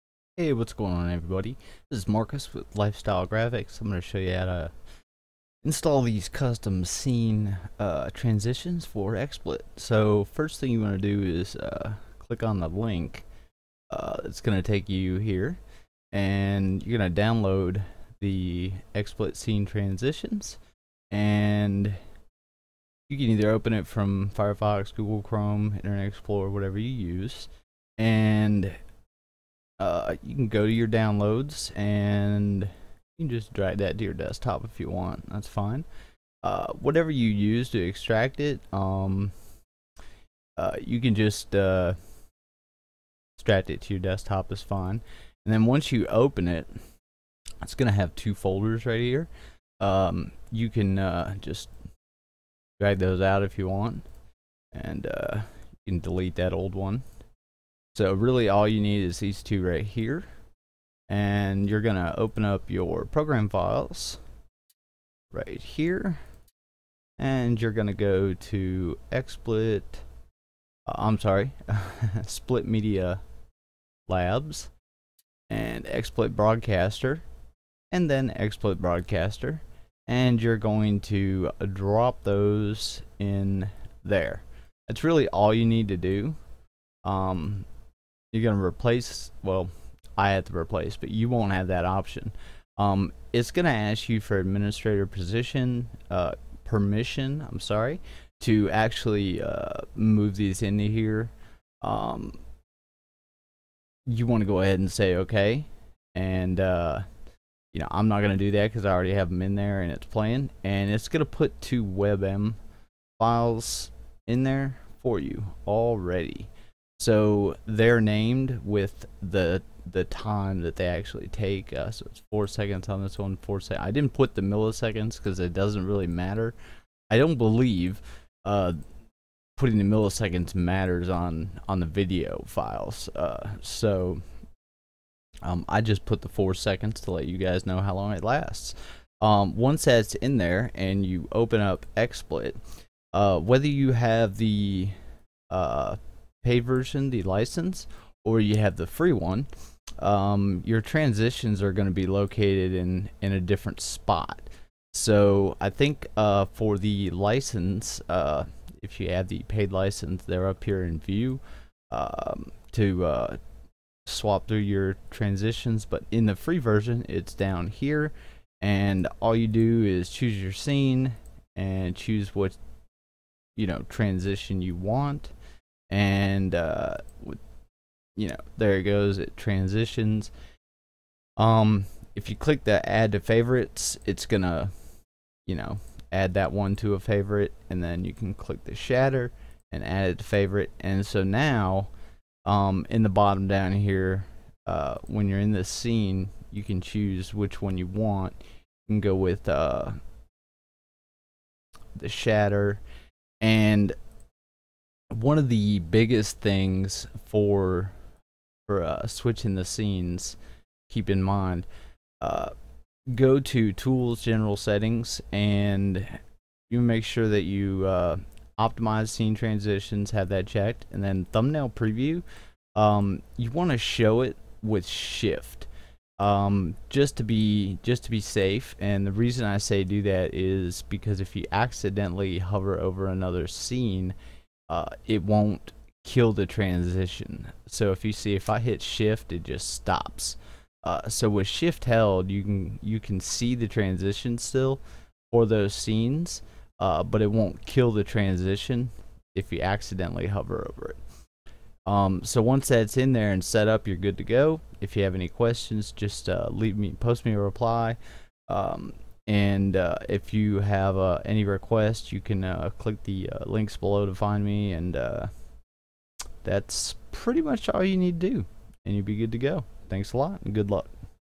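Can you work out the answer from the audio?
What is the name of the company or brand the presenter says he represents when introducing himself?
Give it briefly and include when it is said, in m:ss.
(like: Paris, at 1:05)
LyfeStyle Graphics, at 0:02.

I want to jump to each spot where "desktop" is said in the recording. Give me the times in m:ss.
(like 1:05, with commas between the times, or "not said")
0:34, 0:43.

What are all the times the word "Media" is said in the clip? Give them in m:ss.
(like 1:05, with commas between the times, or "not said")
1:12.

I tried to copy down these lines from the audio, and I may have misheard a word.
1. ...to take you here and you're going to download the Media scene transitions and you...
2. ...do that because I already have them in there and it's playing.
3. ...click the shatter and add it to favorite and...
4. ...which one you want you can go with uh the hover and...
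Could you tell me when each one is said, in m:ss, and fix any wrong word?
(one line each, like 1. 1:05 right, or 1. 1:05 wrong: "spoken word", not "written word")
1. 0:14 wrong: "XSplit", not "Media"
2. 1:48 right
3. 3:08 right
4. 3:17 wrong: "shatter", not "hover".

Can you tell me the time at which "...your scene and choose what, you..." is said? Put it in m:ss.
2:50.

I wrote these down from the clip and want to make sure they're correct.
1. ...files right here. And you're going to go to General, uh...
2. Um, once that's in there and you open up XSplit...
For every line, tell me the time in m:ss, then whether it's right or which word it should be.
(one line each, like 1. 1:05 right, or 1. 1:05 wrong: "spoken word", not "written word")
1. 1:03 wrong: "XSplit", not "General"
2. 2:19 right.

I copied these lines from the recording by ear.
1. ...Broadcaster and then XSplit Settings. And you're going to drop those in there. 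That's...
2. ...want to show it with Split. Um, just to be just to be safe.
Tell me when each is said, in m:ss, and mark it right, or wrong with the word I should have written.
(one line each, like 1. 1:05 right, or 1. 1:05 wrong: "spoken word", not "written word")
1. 1:16 wrong: "Broadcaster", not "Settings"
2. 3:43 wrong: "Shift", not "Split".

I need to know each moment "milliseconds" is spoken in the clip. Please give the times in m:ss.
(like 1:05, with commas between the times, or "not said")
2:04, 2:09.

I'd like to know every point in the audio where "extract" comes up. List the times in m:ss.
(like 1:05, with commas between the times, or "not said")
0:37, 0:43.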